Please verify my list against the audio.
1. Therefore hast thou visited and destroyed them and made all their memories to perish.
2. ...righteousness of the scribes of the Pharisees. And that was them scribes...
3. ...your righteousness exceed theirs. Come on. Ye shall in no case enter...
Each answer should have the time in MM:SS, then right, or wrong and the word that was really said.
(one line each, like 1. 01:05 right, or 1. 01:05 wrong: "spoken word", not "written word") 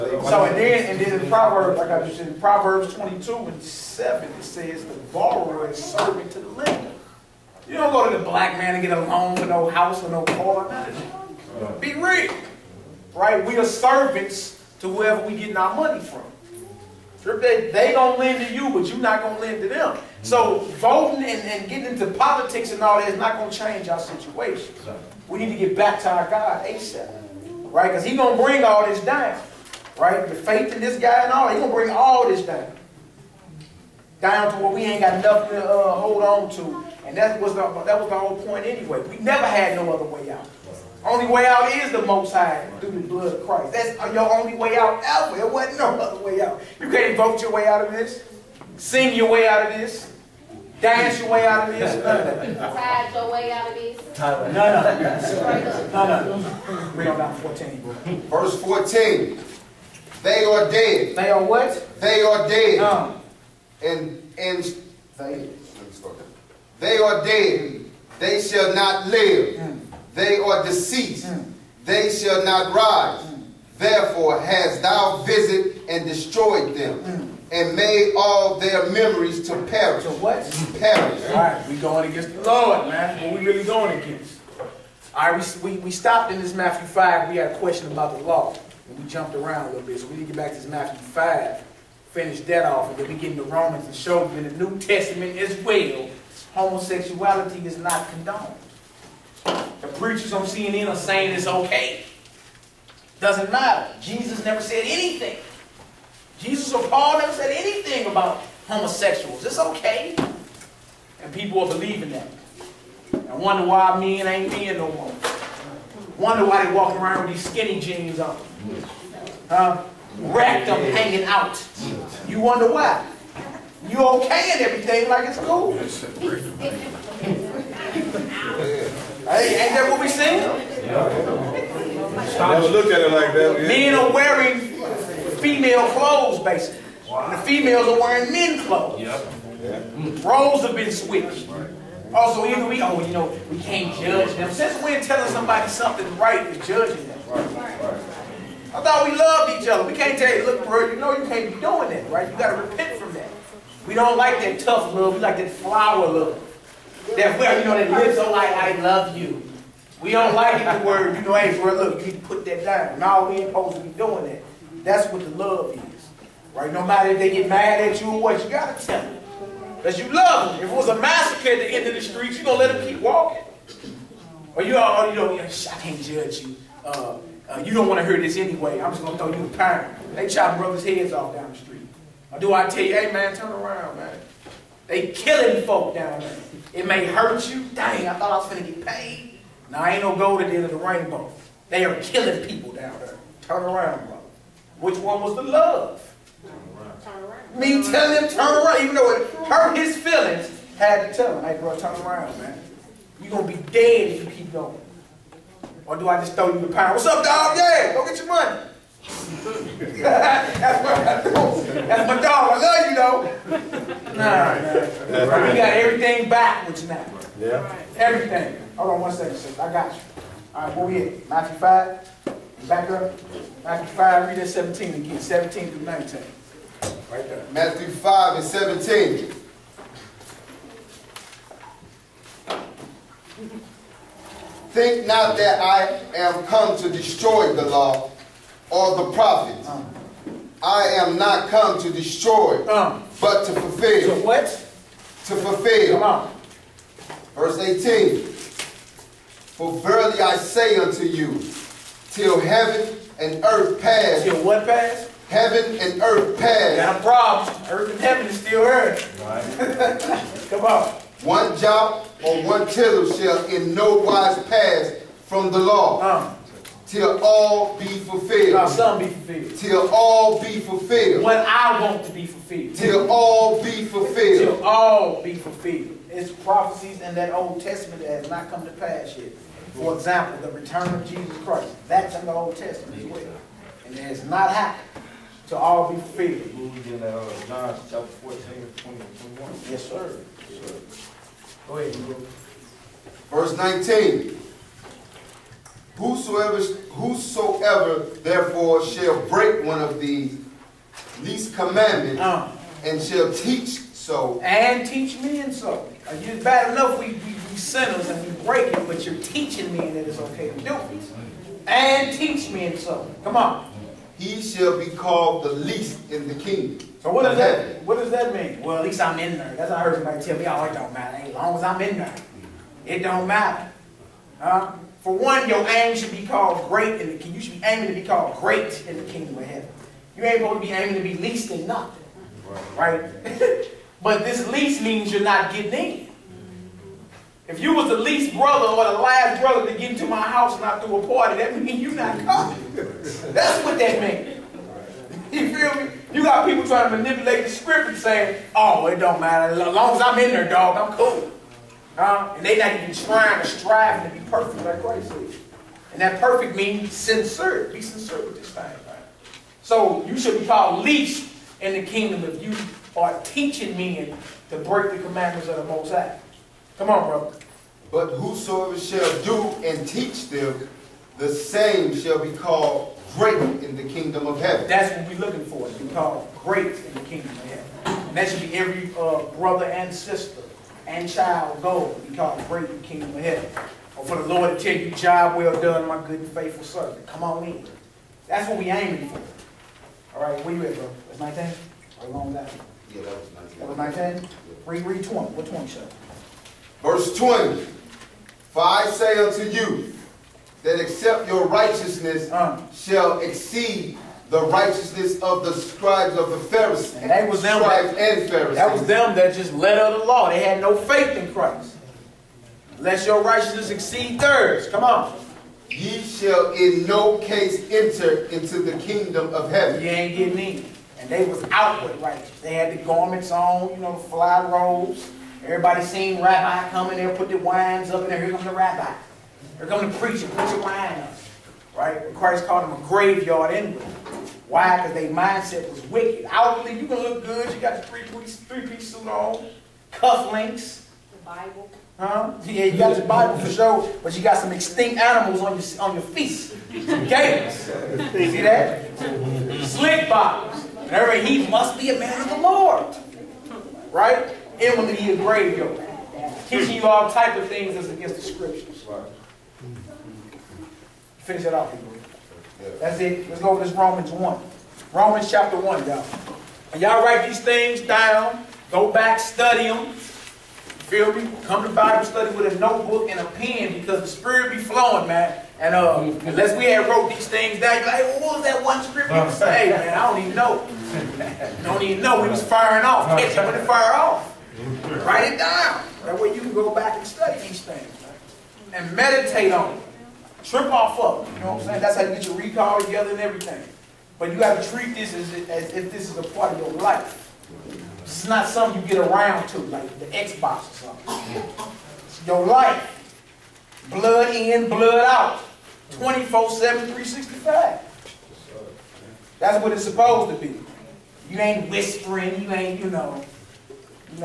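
1. 01:13 right
2. 06:44 right
3. 06:53 right.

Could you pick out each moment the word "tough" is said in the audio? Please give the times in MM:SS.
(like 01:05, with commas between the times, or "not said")
02:34.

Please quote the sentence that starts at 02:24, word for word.
Since when telling somebody something right is judging them?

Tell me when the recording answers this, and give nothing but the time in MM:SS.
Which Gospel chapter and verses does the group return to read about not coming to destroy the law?
03:45.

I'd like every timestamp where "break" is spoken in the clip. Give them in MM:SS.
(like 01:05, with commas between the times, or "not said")
04:59, 05:08, 06:04.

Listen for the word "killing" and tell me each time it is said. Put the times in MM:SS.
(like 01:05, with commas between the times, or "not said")
03:05, 03:12.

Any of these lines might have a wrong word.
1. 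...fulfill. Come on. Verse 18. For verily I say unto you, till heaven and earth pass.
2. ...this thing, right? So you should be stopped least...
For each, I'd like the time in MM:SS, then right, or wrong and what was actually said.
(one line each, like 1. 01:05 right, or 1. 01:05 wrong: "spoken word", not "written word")
1. 04:05 right
2. 05:58 wrong: "called", not "stopped".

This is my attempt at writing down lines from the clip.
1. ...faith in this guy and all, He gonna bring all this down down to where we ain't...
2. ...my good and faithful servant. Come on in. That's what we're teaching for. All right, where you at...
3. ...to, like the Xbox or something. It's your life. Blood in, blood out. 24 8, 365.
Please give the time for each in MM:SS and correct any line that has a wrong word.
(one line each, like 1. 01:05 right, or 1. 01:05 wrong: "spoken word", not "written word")
1. 00:30 right
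2. 06:25 wrong: "aiming", not "teaching"
3. 08:19 wrong: "7", not "8".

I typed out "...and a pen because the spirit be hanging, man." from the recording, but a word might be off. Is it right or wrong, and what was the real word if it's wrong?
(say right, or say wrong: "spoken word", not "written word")
wrong: "flowing", not "hanging".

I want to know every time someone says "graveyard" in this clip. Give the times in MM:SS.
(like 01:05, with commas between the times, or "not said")
07:12, 07:35.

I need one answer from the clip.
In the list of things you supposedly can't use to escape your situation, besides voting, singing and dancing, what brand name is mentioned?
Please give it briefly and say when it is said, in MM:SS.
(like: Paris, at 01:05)
Tide, at 00:52.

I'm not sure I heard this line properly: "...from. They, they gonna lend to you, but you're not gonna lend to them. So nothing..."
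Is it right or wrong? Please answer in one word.
wrong.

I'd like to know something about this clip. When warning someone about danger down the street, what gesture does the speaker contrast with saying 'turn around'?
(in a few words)
A pound.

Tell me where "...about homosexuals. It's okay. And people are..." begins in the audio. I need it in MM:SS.
01:48.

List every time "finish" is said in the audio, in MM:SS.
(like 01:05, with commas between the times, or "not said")
01:32, 07:41.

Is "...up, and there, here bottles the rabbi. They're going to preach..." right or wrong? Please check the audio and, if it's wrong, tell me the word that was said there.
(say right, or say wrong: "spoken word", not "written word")
wrong: "comes", not "bottles".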